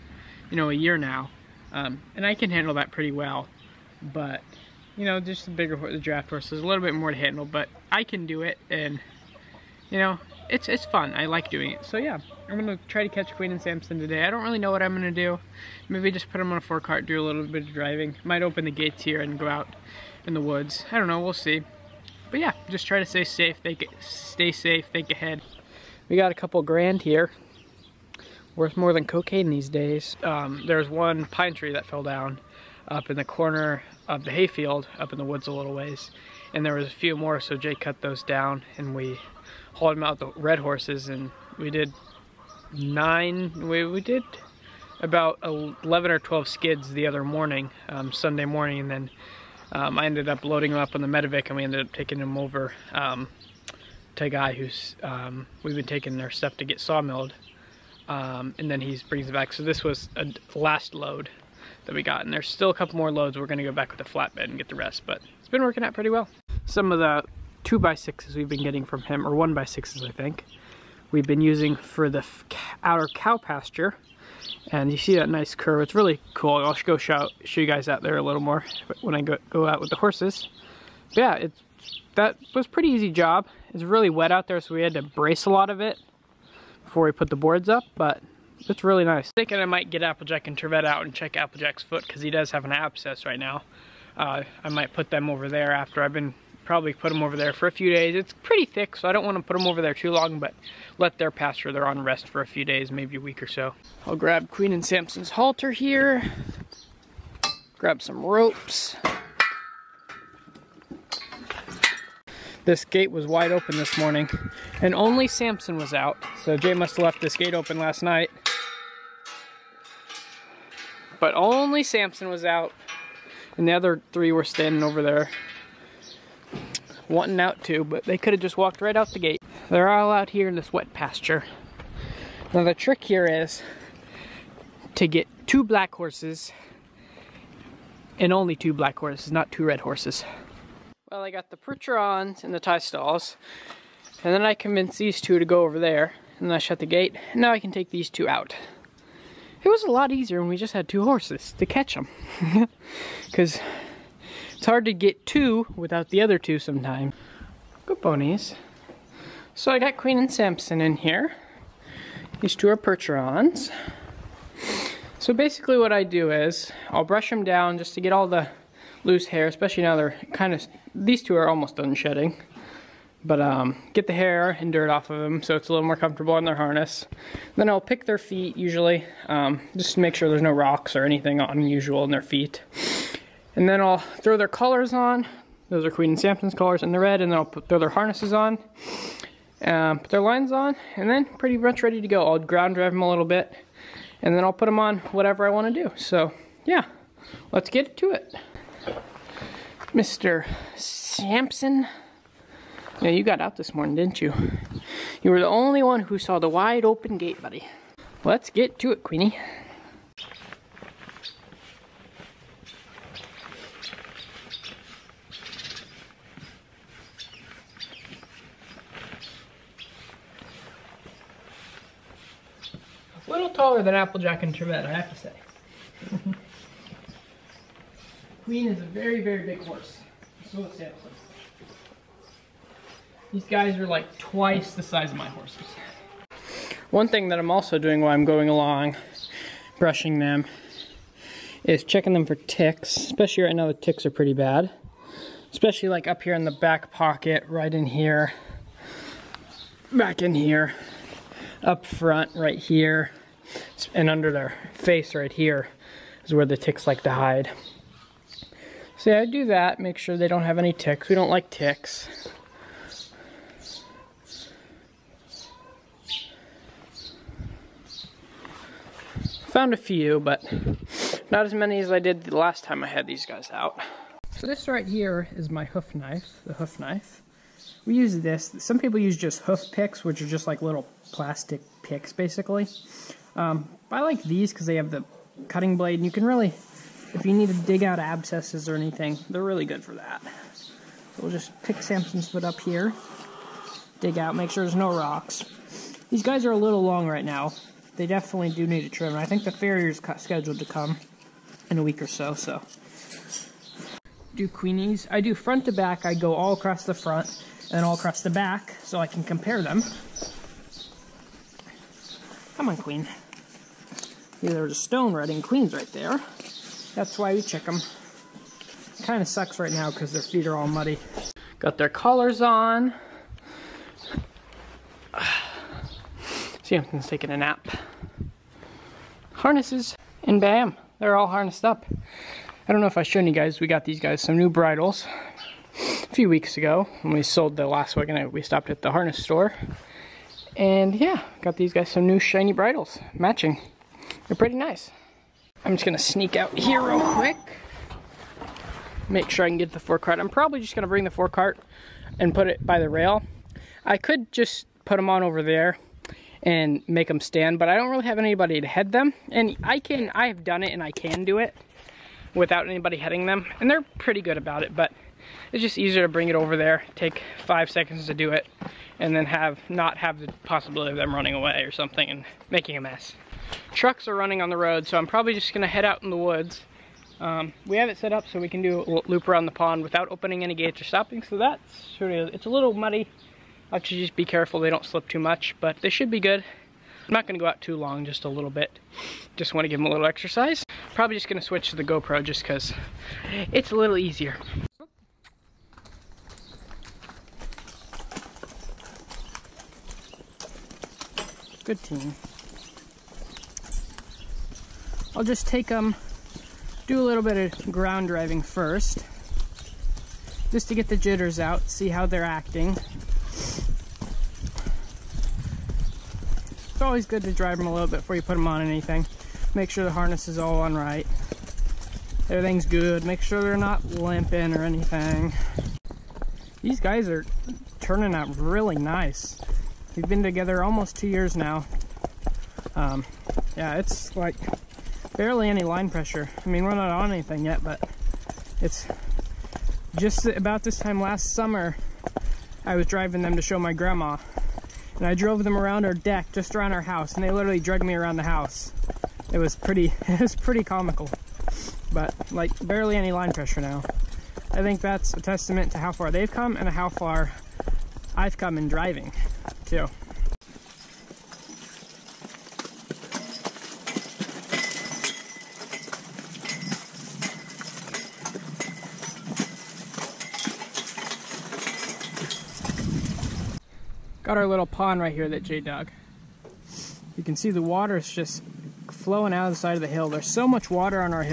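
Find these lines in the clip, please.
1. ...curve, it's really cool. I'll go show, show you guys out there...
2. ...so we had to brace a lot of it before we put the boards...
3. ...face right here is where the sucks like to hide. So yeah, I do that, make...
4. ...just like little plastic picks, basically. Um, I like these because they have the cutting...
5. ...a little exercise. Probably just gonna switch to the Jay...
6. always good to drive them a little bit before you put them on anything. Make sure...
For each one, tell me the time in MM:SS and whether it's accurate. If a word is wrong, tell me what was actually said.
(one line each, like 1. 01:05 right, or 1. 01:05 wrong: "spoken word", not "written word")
1. 01:15 right
2. 01:24 right
3. 04:14 wrong: "ticks", not "sucks"
4. 04:40 right
5. 06:29 wrong: "GoPro", not "Jay"
6. 06:56 right.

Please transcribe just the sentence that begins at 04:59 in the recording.
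I think the farrier's scheduled to come in a week or so, so.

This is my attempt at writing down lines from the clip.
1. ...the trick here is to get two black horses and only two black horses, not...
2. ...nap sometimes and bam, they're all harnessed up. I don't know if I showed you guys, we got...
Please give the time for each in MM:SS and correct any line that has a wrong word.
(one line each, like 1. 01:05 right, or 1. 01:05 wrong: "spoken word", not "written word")
1. 02:12 right
2. 05:27 wrong: "harnesses", not "sometimes".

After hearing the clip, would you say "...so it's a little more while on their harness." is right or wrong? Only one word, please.
wrong.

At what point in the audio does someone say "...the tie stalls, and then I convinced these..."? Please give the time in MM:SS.
02:22.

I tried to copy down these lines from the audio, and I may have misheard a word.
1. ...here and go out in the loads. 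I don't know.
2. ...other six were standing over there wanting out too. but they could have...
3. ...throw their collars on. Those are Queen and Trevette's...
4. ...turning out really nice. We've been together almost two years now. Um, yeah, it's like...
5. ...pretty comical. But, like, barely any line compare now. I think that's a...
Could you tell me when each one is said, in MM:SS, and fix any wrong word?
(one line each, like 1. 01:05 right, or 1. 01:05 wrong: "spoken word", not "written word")
1. 00:19 wrong: "woods", not "loads"
2. 02:03 wrong: "three", not "six"
3. 03:03 wrong: "Sampson", not "Trevette"
4. 07:07 right
5. 07:30 wrong: "pressure", not "compare".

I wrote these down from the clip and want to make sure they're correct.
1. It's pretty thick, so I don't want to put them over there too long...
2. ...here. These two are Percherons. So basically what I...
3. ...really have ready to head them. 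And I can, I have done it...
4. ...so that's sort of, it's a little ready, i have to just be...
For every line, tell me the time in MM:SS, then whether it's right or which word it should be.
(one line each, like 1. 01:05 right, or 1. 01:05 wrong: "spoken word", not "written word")
1. 01:38 right
2. 02:40 right
3. 05:57 wrong: "anybody", not "ready"
4. 06:21 wrong: "muddy", not "ready".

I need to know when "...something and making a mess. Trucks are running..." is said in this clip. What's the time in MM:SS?
06:11.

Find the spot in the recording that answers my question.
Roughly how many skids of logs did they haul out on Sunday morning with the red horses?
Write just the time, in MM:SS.
00:45.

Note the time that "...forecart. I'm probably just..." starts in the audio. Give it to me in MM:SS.
05:49.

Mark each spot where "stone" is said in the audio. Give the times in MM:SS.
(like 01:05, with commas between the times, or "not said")
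05:14.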